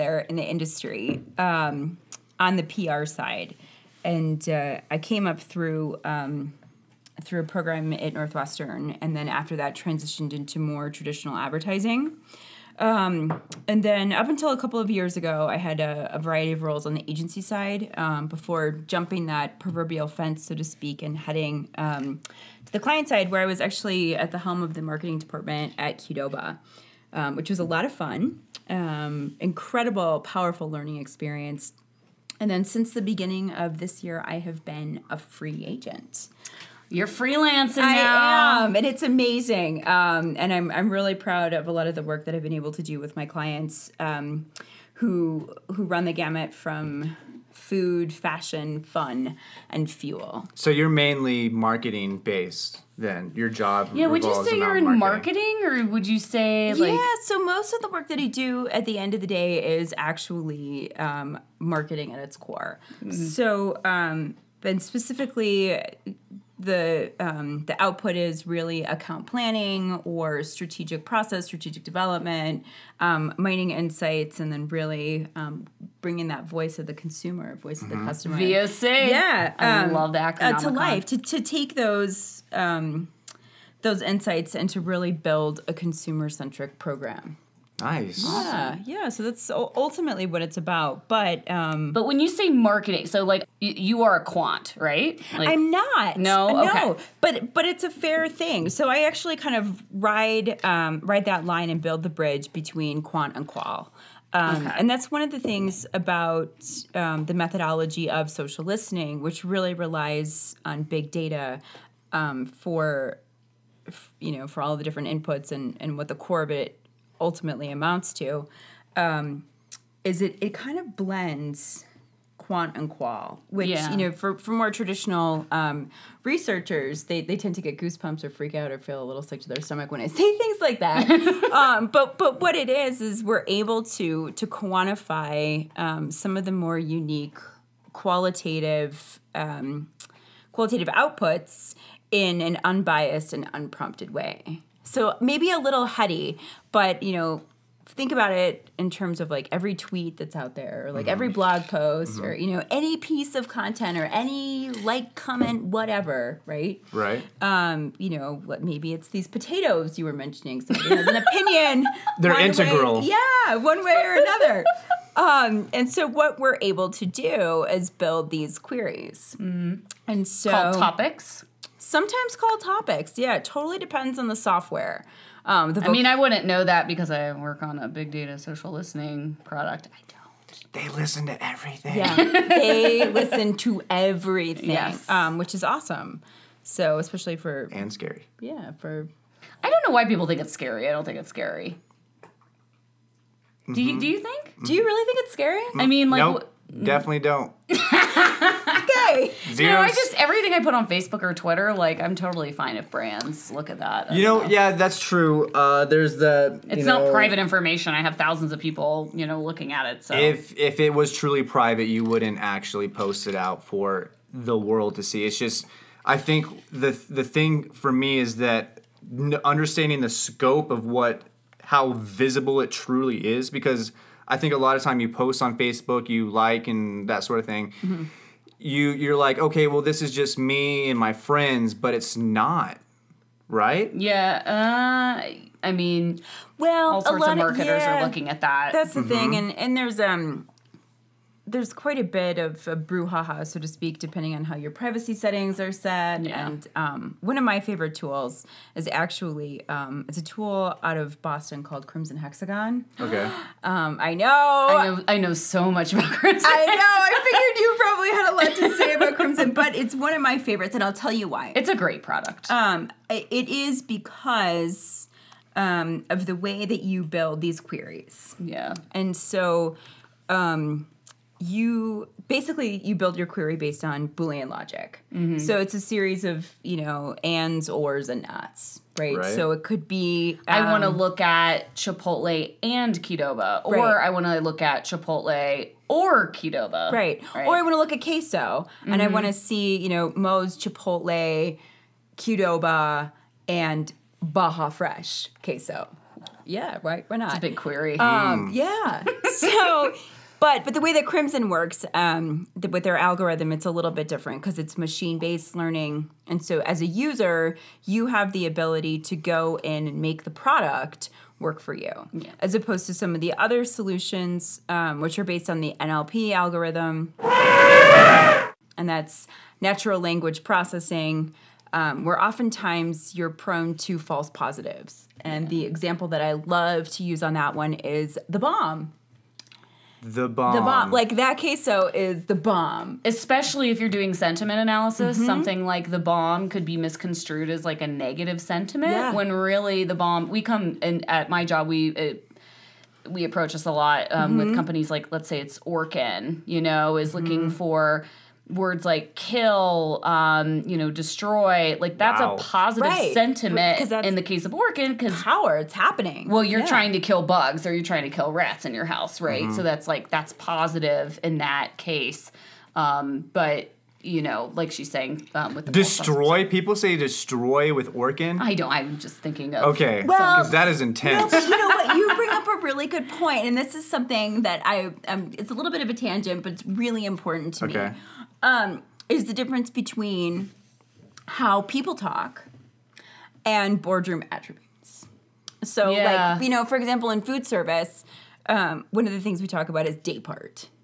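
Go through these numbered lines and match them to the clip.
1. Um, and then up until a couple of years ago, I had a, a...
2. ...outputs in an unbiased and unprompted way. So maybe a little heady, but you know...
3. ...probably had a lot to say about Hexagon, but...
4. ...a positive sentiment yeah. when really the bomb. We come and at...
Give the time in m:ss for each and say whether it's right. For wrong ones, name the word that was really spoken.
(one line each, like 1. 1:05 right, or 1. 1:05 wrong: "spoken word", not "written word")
1. 0:12 right
2. 2:20 right
3. 4:17 wrong: "Crimson", not "Hexagon"
4. 5:37 wrong: "negative", not "positive".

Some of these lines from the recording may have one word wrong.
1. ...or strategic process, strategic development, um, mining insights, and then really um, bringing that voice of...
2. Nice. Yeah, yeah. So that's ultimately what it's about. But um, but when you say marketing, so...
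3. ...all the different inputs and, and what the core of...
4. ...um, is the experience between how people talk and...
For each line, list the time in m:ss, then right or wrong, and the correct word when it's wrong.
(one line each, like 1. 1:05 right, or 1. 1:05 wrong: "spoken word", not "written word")
1. 1:10 right
2. 1:27 right
3. 1:54 right
4. 6:18 wrong: "difference", not "experience".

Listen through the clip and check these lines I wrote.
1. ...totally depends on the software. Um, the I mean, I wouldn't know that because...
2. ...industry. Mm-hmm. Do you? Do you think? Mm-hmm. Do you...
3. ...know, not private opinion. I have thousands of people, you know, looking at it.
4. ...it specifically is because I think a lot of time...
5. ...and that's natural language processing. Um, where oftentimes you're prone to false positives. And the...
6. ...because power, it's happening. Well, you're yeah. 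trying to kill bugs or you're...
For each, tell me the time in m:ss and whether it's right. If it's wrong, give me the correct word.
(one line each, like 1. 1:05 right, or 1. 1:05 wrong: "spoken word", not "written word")
1. 2:53 right
2. 3:11 wrong: "scary", not "industry"
3. 3:26 wrong: "information", not "opinion"
4. 3:42 wrong: "truly", not "specifically"
5. 5:17 right
6. 5:54 right.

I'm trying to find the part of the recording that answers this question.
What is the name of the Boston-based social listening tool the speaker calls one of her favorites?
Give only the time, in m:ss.
4:11.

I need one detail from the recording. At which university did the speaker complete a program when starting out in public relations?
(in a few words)
Northwestern.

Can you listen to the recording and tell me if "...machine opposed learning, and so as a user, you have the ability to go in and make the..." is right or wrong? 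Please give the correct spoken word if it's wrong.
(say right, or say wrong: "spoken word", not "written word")
wrong: "based", not "opposed".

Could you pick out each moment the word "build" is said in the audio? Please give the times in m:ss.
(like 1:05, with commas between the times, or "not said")
1:25, 1:41, 2:47, 4:27, 4:32.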